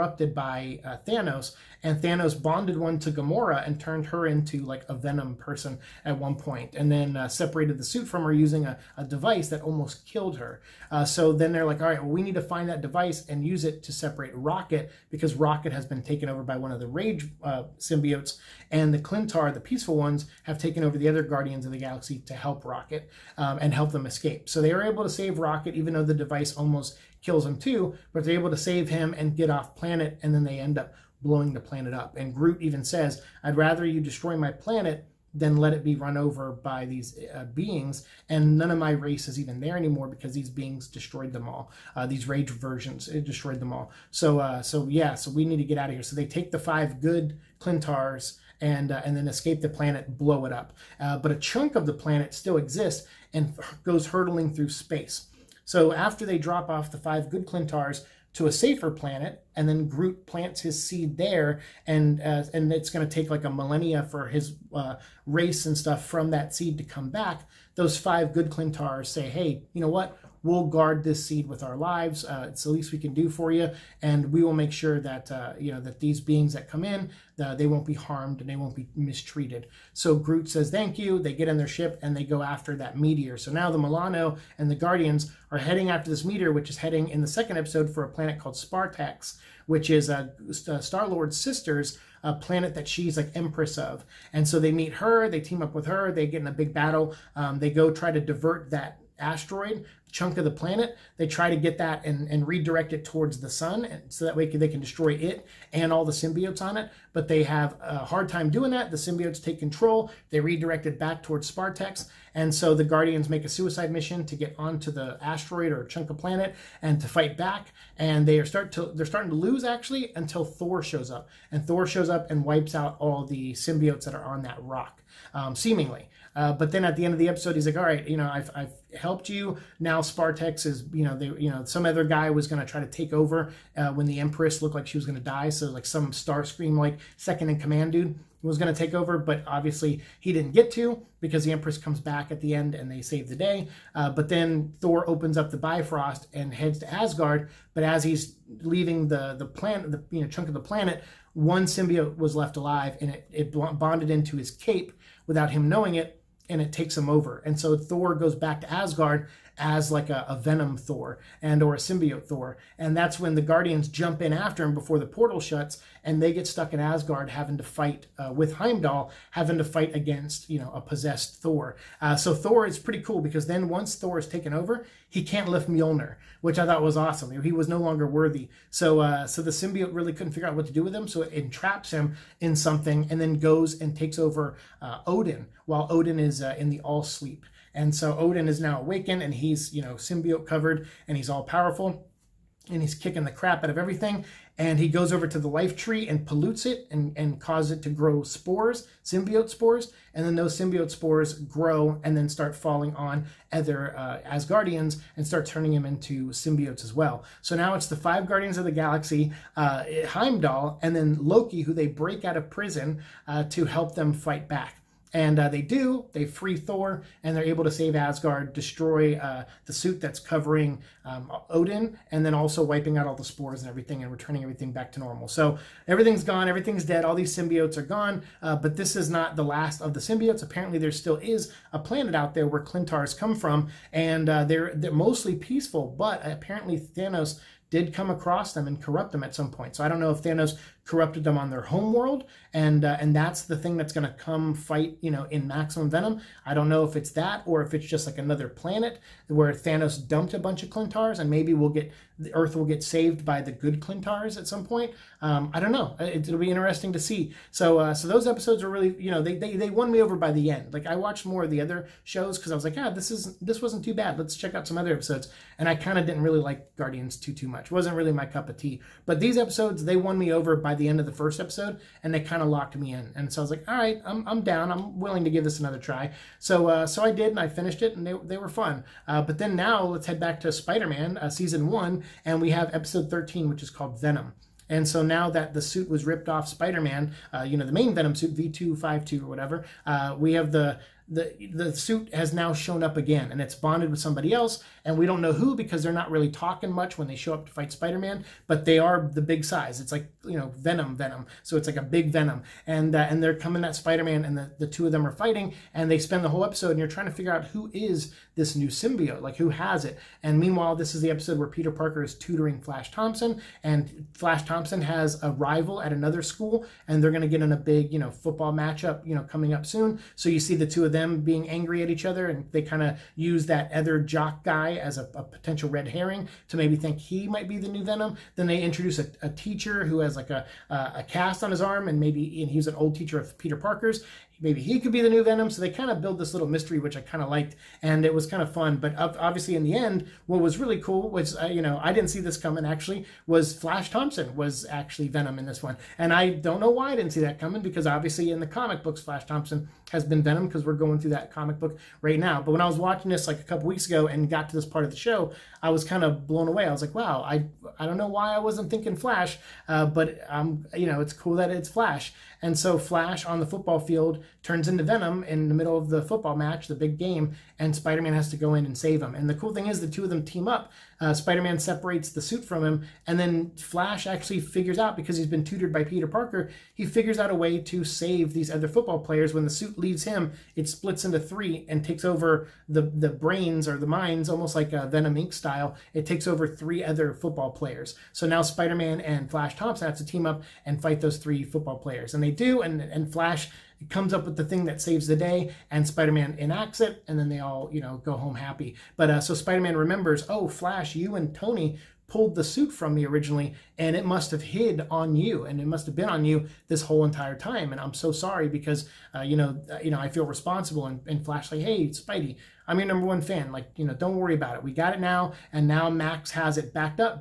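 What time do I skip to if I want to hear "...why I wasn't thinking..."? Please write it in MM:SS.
05:58.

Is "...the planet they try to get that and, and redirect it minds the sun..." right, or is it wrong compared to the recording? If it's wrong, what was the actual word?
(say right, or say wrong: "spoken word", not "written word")
wrong: "towards", not "minds".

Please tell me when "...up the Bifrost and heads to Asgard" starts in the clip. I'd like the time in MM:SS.
02:25.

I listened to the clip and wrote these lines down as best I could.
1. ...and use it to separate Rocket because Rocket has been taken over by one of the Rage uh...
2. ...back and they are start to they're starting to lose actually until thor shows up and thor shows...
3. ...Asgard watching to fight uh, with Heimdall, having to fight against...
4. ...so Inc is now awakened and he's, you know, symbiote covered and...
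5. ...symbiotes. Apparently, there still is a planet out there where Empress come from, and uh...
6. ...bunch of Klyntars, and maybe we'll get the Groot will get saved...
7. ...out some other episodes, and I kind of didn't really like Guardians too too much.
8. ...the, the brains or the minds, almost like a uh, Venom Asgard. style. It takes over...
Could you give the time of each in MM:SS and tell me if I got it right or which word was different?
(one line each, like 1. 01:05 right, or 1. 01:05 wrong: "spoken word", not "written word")
1. 00:13 right
2. 01:57 right
3. 02:46 wrong: "having", not "watching"
4. 03:07 wrong: "Odin", not "Inc"
5. 03:49 wrong: "Klyntars", not "Empress"
6. 04:10 wrong: "Earth", not "Groot"
7. 04:24 right
8. 06:22 wrong: "Inc", not "Asgard".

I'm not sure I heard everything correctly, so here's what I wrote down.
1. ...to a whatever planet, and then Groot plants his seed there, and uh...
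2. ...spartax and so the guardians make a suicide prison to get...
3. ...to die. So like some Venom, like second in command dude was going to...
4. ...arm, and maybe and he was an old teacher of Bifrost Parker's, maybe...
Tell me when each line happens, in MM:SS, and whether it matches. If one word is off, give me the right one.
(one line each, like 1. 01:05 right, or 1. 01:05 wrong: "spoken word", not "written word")
1. 00:58 wrong: "safer", not "whatever"
2. 01:51 wrong: "mission", not "prison"
3. 02:15 wrong: "Starscream", not "Venom"
4. 05:31 wrong: "Peter", not "Bifrost".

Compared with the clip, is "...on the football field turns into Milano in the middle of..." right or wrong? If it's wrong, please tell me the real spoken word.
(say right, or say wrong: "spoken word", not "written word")
wrong: "Venom", not "Milano".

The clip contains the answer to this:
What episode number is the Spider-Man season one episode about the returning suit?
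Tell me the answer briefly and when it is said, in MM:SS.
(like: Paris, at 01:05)
13, at 04:43.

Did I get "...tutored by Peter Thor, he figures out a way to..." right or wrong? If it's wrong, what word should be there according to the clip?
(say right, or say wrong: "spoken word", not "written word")
wrong: "Parker", not "Thor".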